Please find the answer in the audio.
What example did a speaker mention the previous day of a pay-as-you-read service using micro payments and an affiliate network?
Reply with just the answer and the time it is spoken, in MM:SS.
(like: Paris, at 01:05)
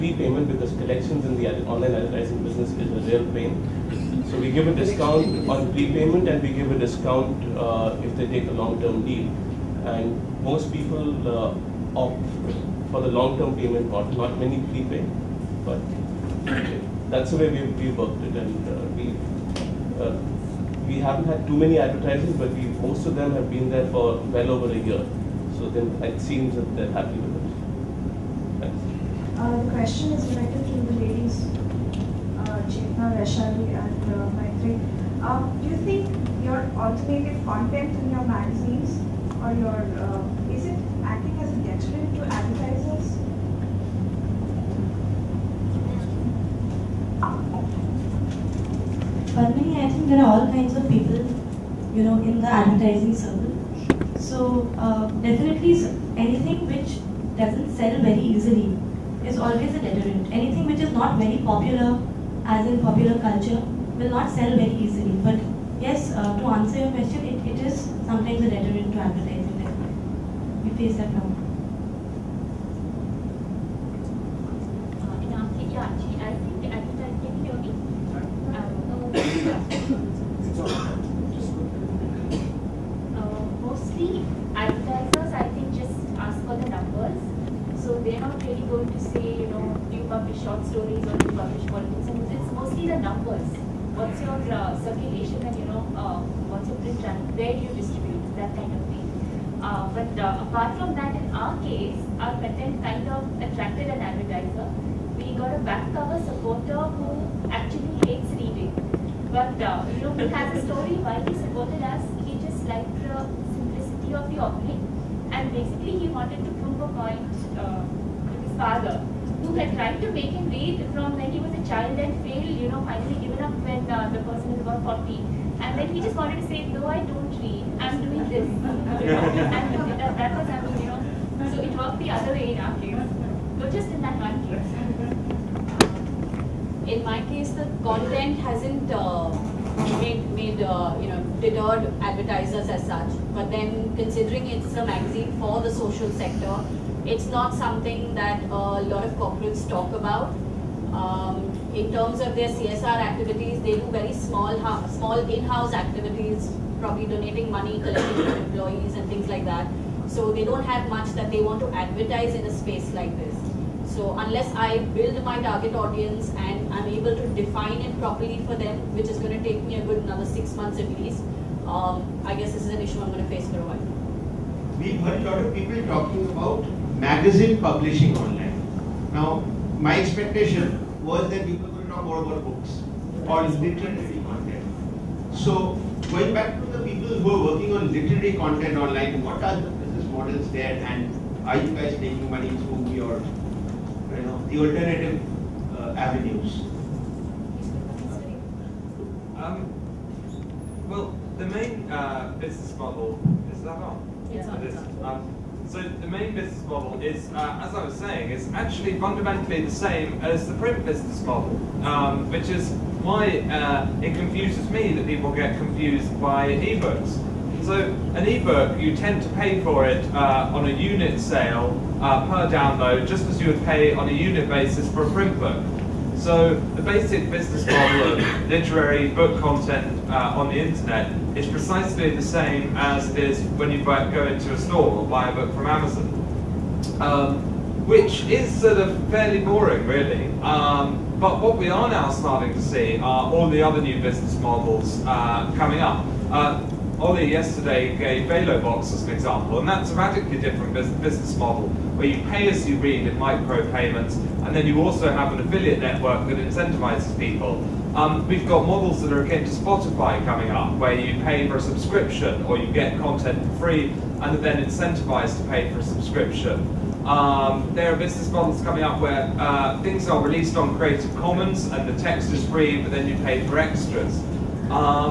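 ValoBox, at 04:08.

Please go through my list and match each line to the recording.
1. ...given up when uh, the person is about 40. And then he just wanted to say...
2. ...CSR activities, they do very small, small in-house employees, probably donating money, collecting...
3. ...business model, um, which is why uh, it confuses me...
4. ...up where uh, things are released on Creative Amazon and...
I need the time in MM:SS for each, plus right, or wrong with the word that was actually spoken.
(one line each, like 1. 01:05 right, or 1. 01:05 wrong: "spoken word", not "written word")
1. 02:03 right
2. 02:32 wrong: "activities", not "employees"
3. 03:30 right
4. 04:28 wrong: "Commons", not "Amazon".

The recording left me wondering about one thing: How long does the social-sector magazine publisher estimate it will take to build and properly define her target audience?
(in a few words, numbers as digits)
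6 months.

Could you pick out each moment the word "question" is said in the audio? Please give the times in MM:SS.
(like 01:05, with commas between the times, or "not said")
00:29, 01:06.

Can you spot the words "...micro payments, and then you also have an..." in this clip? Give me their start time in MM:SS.
04:13.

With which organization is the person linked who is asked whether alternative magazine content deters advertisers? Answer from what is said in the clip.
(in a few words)
Maitri.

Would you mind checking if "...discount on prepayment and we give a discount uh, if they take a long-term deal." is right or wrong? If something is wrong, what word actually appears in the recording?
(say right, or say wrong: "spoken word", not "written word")
right.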